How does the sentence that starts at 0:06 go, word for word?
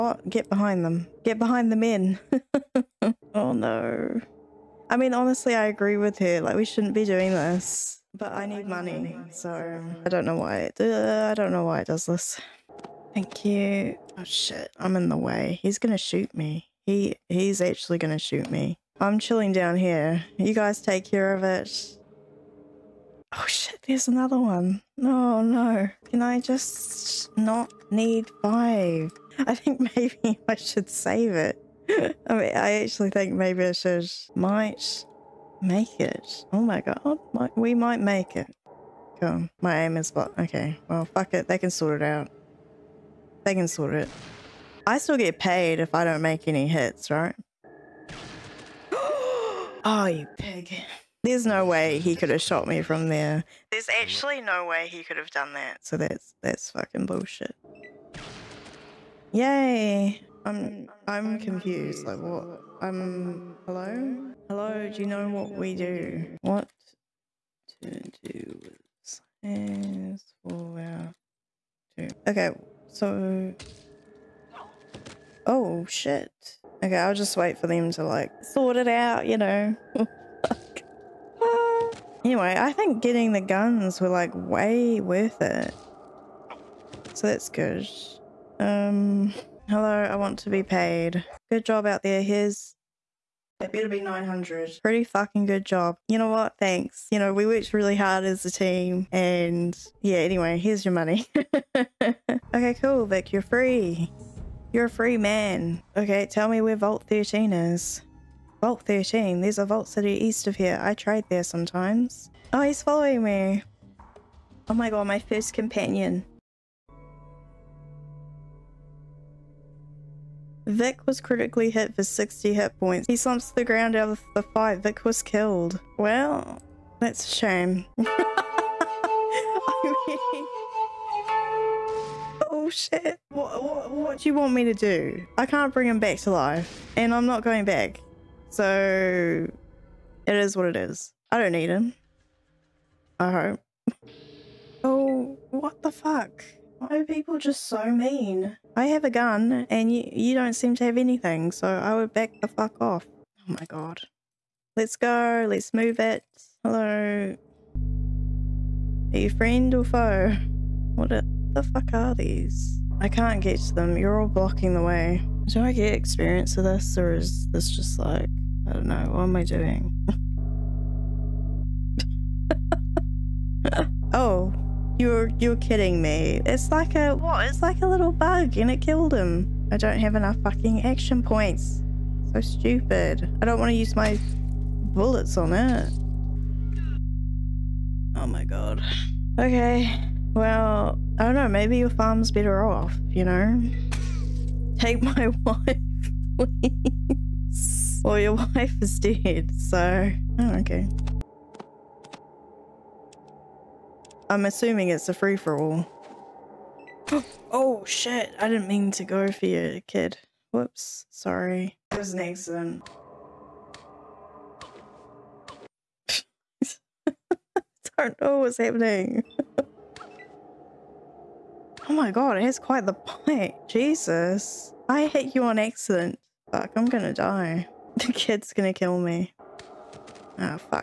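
Like, we shouldn't be doing this.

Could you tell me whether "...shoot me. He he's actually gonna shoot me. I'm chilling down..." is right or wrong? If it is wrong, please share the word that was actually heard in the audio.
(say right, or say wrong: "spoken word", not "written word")
right.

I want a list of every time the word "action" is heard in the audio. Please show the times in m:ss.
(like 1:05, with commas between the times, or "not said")
3:00.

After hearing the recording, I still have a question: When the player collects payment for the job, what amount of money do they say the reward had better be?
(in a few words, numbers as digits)
900.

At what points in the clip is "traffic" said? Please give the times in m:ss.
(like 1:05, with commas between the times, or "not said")
not said.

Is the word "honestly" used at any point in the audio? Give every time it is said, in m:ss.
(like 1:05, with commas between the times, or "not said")
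0:05.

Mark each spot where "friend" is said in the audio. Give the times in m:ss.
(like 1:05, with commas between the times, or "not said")
2:39.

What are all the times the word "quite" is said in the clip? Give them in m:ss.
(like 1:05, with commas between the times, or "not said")
3:42.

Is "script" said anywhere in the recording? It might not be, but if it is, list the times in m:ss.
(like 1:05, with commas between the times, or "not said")
not said.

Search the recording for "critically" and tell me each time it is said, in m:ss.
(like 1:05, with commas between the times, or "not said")
2:01.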